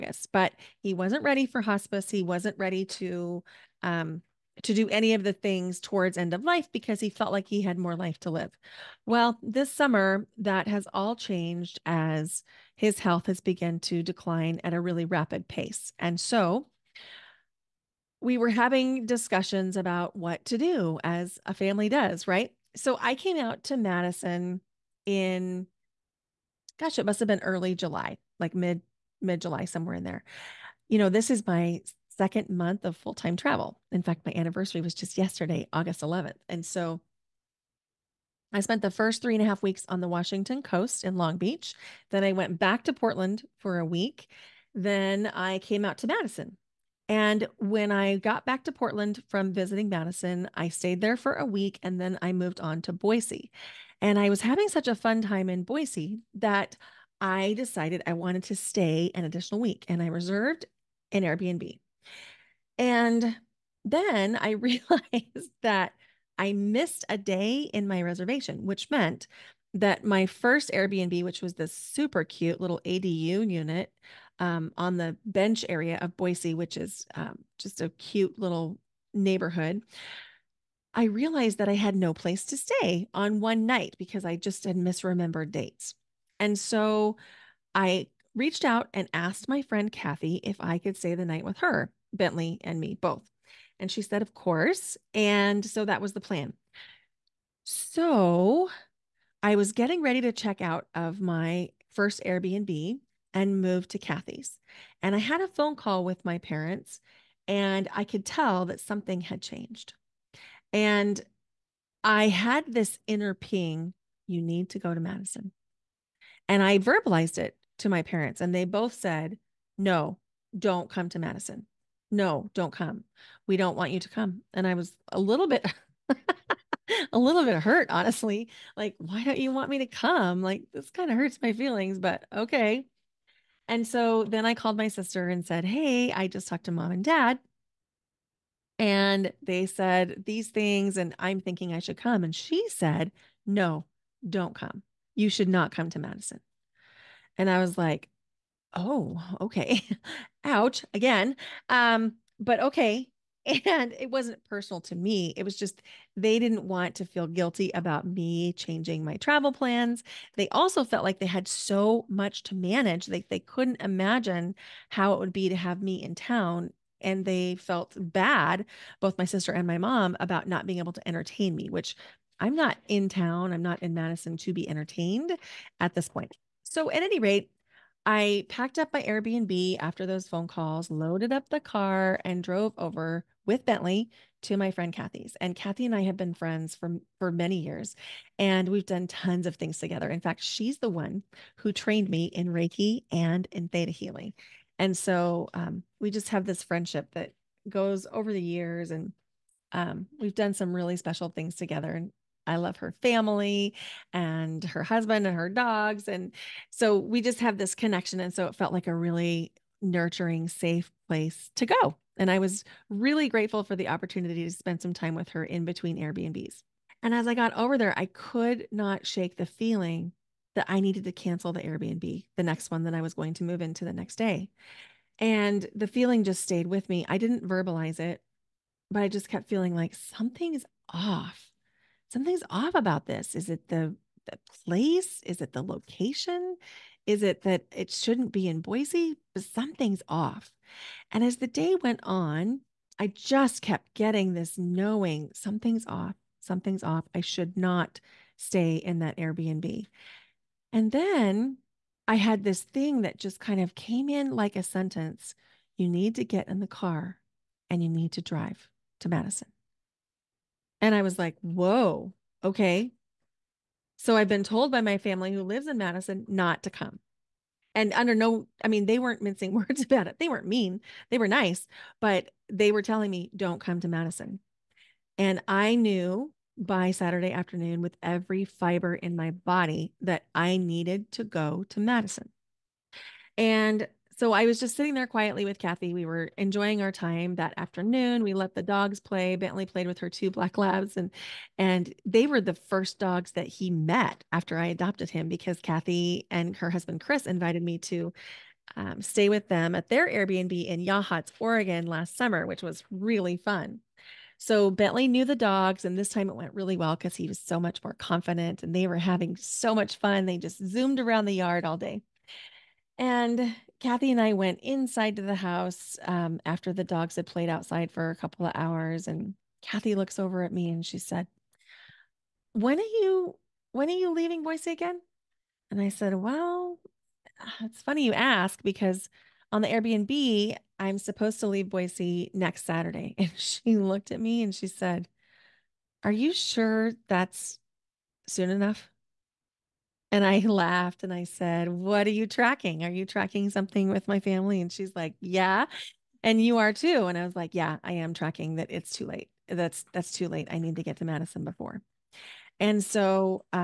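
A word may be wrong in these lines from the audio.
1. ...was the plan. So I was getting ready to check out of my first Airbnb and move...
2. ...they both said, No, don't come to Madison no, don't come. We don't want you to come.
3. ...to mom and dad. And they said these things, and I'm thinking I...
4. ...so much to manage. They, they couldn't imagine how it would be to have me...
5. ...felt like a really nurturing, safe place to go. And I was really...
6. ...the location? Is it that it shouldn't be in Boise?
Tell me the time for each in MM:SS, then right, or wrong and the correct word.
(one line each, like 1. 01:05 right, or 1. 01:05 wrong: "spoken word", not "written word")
1. 01:36 right
2. 01:58 right
3. 02:16 right
4. 02:41 right
5. 03:28 right
6. 03:55 right.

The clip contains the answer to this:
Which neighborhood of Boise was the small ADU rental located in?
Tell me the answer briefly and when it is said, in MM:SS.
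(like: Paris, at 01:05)
the bench, at 01:15.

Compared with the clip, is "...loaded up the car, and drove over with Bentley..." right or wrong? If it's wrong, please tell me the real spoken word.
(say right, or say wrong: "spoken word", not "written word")
right.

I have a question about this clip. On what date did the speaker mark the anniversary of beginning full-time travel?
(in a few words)
August 11th.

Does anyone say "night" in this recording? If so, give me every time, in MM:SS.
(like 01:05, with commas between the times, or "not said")
01:23, 01:31.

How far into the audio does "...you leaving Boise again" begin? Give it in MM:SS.
05:23.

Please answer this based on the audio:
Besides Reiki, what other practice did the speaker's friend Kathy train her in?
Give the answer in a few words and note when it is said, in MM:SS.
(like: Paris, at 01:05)
Theta healing, at 03:13.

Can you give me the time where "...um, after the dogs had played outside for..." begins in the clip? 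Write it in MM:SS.
05:16.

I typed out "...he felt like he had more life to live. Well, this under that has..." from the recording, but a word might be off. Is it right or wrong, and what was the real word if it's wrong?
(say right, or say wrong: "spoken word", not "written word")
wrong: "summer", not "under".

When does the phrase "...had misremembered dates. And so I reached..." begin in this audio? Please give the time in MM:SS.
01:24.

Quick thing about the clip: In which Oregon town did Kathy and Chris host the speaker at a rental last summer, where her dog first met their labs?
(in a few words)
Yachats.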